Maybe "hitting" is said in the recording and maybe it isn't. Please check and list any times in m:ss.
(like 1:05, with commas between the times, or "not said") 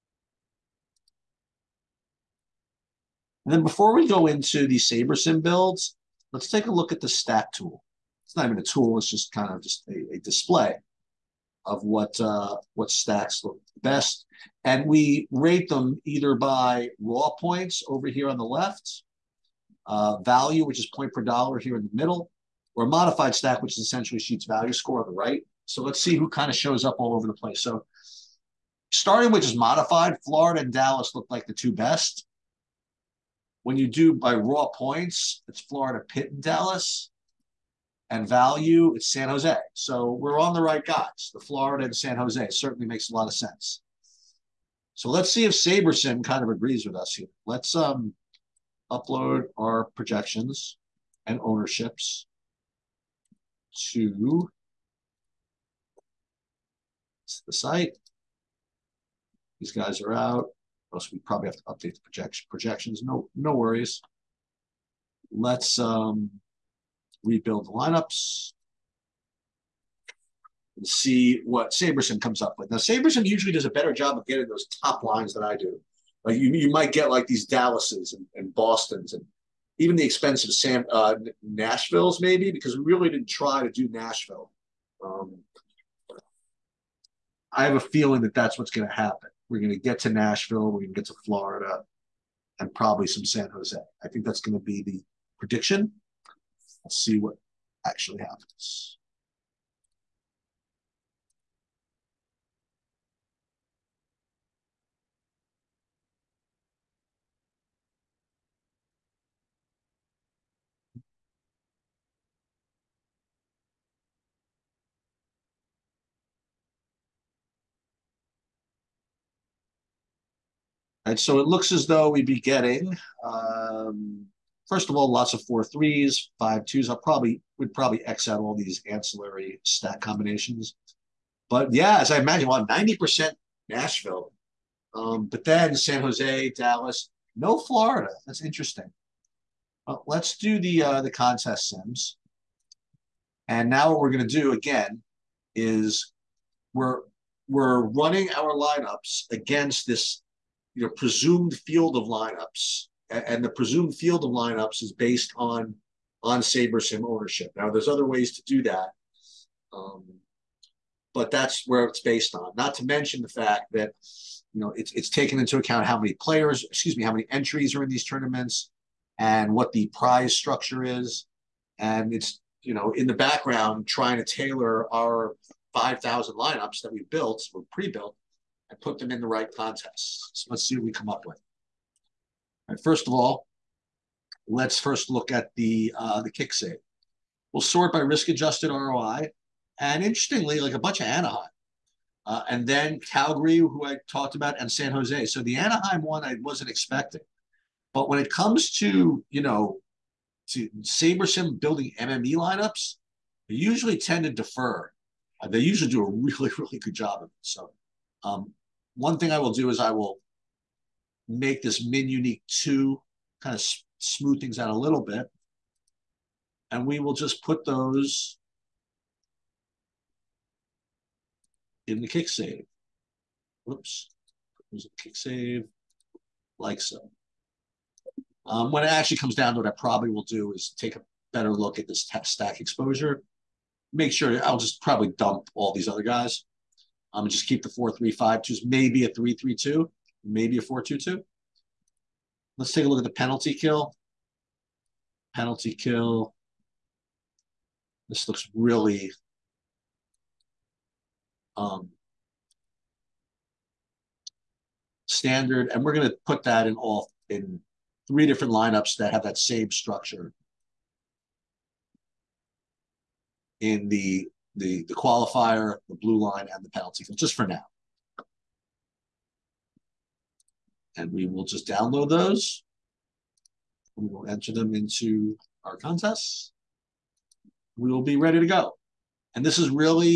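not said.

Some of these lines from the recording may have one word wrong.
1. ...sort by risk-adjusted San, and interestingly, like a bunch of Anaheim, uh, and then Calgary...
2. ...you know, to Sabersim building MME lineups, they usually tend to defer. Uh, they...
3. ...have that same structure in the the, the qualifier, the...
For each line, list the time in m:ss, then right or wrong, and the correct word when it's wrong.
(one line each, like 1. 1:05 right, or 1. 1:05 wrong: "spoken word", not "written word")
1. 3:07 wrong: "ROI", not "San"
2. 3:19 right
3. 4:19 right.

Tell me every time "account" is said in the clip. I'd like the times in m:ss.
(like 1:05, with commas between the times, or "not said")
2:45.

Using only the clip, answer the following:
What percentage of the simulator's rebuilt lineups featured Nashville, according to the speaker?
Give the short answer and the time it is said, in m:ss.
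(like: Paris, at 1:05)
90%, at 2:12.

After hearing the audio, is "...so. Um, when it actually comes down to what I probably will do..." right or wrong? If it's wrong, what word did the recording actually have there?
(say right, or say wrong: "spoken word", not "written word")
right.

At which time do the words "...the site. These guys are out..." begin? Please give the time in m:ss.
0:57.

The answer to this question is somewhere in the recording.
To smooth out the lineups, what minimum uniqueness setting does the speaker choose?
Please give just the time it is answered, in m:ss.
3:31.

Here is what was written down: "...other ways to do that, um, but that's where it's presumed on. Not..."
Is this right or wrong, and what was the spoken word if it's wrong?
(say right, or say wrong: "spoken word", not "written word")
wrong: "based", not "presumed".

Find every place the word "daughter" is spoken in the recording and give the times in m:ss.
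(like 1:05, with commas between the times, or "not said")
not said.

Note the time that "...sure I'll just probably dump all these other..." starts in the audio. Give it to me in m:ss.
3:54.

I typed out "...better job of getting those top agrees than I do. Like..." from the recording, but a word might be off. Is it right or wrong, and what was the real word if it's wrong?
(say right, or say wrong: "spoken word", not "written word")
wrong: "lines", not "agrees".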